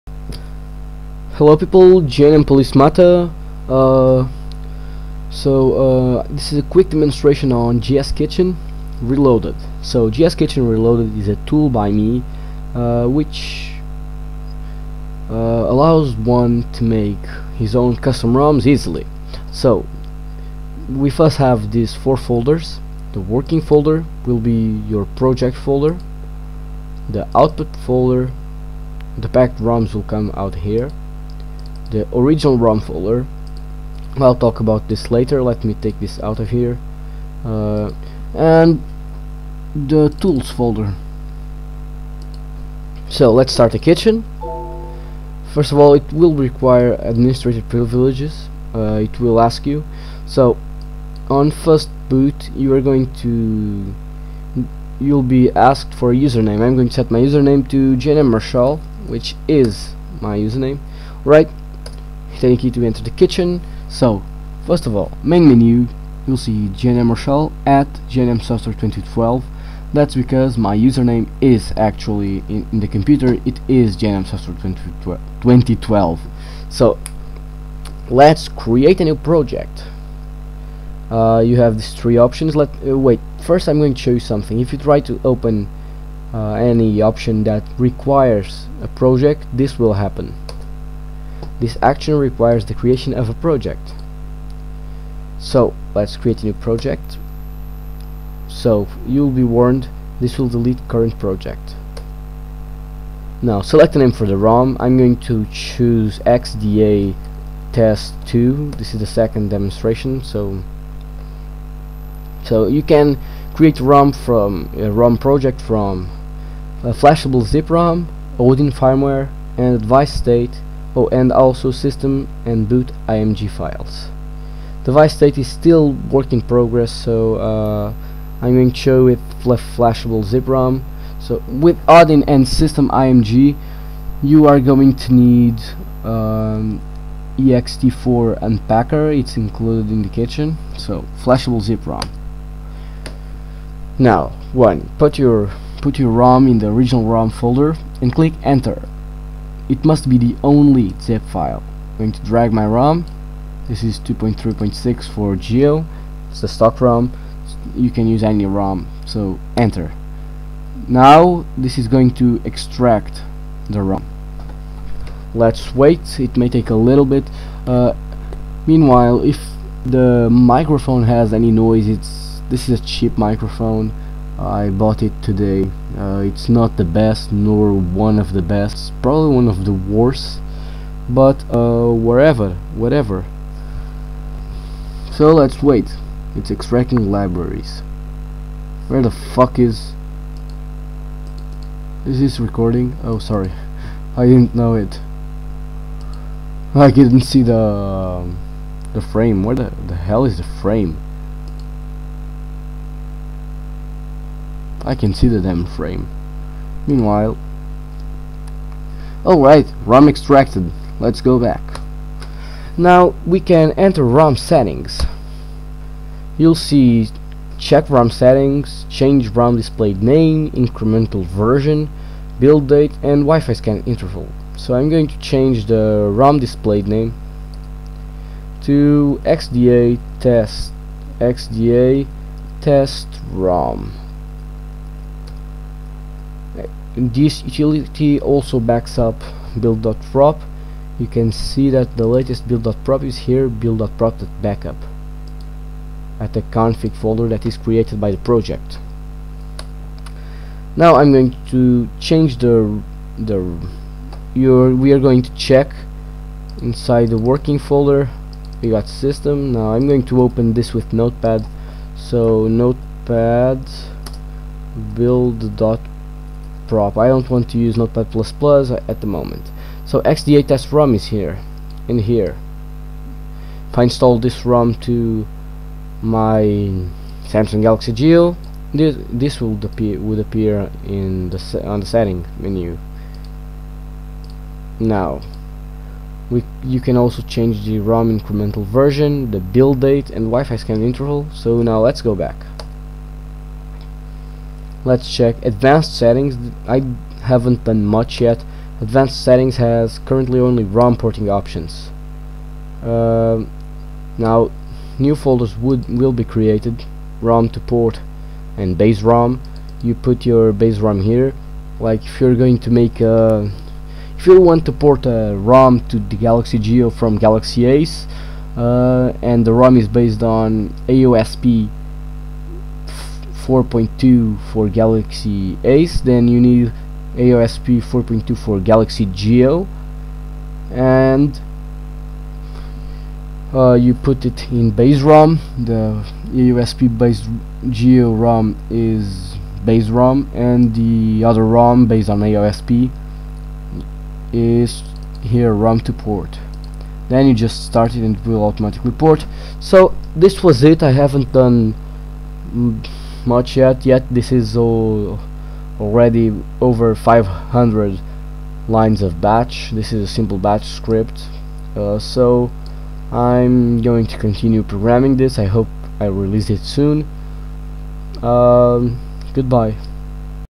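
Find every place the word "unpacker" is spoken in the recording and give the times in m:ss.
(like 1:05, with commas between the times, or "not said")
2:18.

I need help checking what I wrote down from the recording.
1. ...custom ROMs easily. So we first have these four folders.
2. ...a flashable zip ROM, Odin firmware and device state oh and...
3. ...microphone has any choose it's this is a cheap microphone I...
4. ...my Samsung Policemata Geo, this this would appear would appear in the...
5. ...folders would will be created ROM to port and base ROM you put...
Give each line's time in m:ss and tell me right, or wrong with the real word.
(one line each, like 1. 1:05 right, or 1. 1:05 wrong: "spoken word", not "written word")
1. 0:17 right
2. 1:56 right
3. 2:50 wrong: "noise", not "choose"
4. 4:36 wrong: "Galaxy", not "Policemata"
5. 5:05 right.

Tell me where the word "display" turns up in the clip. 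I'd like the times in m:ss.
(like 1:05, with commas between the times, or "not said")
3:39, 3:46.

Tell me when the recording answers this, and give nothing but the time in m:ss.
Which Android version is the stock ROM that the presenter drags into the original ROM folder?
2:34.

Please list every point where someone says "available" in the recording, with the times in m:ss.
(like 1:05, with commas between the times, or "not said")
not said.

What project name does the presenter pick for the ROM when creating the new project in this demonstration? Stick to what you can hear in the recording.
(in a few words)
XDA test 2.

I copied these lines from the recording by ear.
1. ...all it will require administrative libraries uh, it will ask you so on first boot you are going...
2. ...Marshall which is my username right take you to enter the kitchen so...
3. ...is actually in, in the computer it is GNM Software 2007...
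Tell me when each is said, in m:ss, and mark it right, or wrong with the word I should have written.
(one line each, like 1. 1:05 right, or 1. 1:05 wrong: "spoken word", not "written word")
1. 0:45 wrong: "privileges", not "libraries"
2. 0:58 right
3. 1:11 wrong: "2012", not "2007".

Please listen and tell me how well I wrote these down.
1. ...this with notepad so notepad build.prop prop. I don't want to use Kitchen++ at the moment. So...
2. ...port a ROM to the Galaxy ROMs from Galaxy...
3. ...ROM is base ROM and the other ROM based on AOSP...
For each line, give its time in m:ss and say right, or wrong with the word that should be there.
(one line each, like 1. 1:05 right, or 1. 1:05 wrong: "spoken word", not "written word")
1. 4:20 wrong: "Notepad", not "Kitchen"
2. 5:14 wrong: "Geo", not "ROMs"
3. 5:38 right.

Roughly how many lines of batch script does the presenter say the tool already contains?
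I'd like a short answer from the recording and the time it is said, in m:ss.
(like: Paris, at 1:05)
over 500, at 5:56.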